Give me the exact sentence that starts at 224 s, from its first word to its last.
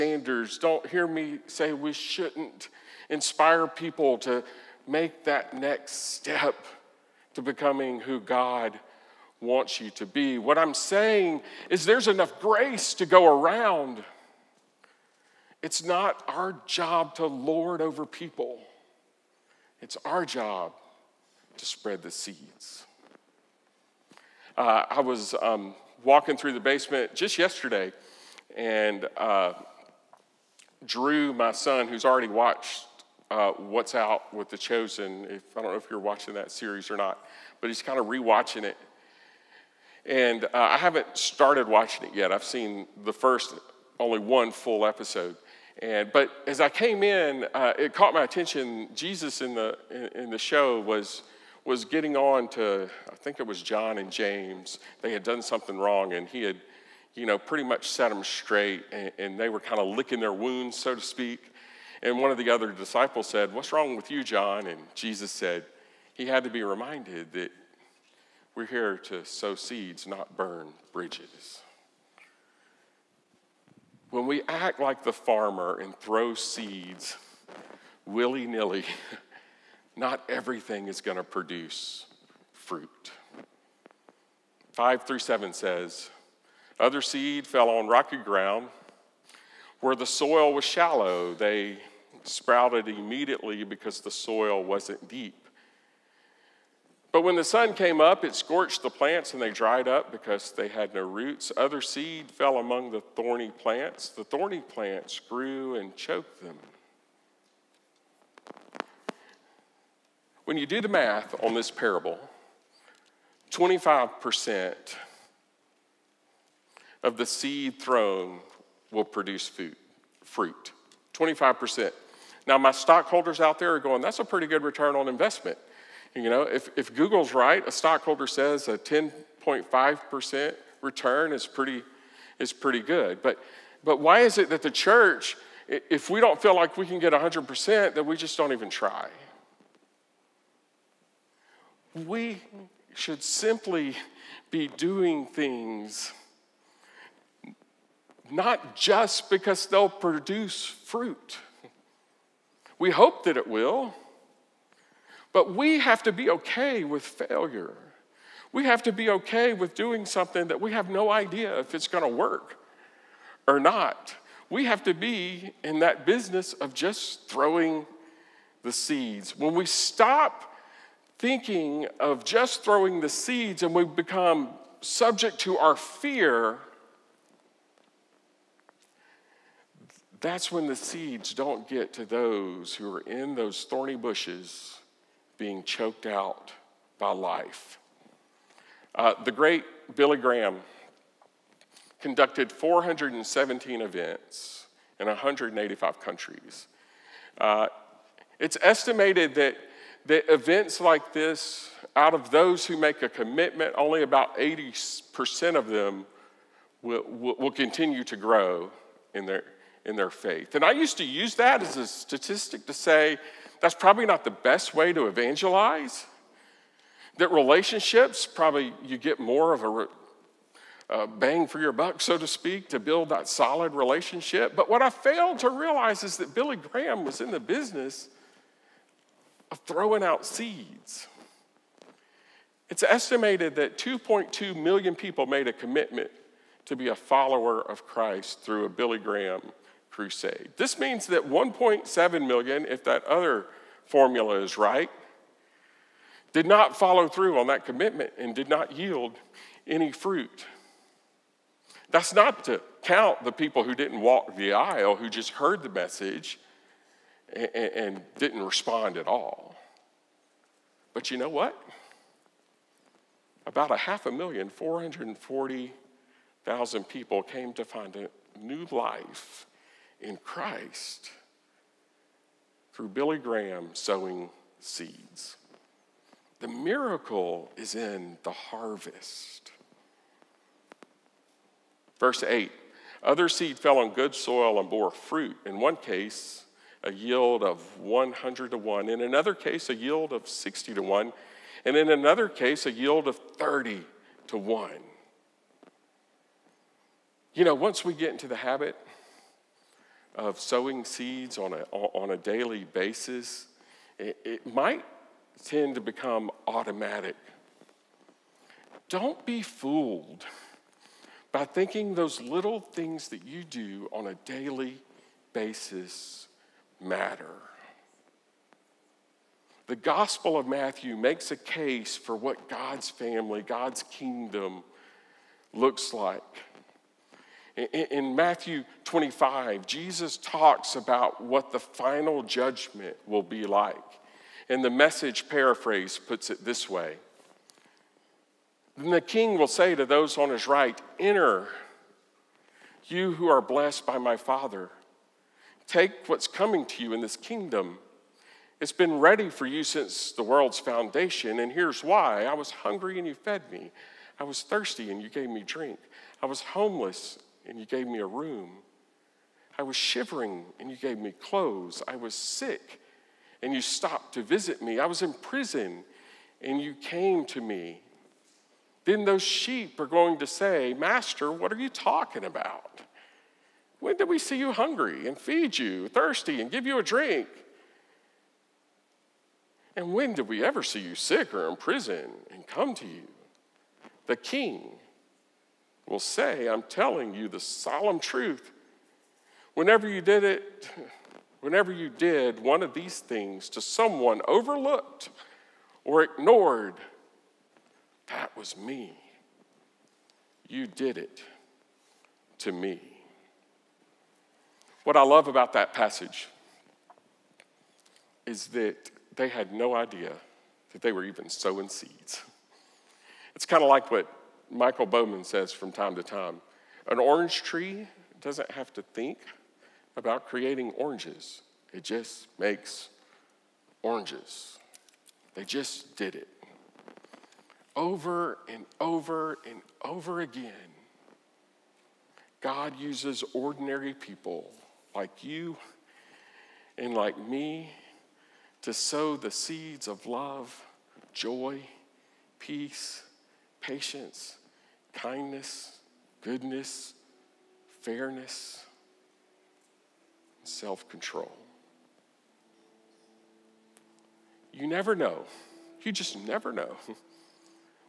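But what I failed to realize is that Billy Graham was in the business of throwing out seeds.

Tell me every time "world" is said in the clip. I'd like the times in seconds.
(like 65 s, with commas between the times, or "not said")
350 s.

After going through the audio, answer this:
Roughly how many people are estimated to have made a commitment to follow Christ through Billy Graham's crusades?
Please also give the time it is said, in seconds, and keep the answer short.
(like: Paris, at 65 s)
2.2 million, at 233 s.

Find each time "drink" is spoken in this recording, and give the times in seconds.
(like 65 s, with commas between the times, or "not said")
355 s, 376 s.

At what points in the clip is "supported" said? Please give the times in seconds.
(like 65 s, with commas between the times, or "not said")
not said.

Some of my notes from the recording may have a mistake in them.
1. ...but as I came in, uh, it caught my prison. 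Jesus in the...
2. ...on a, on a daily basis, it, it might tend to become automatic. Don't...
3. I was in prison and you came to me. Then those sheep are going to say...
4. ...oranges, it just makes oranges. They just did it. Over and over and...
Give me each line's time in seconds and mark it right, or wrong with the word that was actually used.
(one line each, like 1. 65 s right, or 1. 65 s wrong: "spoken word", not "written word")
1. 46 s wrong: "attention", not "prison"
2. 301 s right
3. 364 s right
4. 420 s right.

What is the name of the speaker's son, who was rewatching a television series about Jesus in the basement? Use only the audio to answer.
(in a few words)
Drew.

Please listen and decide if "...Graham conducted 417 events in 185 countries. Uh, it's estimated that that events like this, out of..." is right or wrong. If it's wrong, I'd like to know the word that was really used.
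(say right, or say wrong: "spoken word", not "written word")
right.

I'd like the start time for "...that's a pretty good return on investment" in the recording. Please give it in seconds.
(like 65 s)
124 s.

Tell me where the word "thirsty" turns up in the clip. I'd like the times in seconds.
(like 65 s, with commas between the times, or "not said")
354 s, 375 s.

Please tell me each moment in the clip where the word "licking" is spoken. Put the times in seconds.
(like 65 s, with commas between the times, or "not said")
59 s.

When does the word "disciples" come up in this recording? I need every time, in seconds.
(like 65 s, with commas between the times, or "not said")
62 s.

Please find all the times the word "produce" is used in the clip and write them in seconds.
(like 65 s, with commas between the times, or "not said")
81 s, 119 s, 149 s.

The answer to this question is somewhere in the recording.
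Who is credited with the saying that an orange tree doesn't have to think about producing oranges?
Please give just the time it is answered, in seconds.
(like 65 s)
414 s.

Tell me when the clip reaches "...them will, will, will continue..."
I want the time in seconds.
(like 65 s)
205 s.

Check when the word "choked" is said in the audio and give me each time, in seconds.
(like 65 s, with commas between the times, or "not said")
105 s, 185 s.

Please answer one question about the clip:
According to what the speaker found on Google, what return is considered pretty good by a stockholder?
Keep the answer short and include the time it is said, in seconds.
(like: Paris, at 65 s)
10.5%, at 128 s.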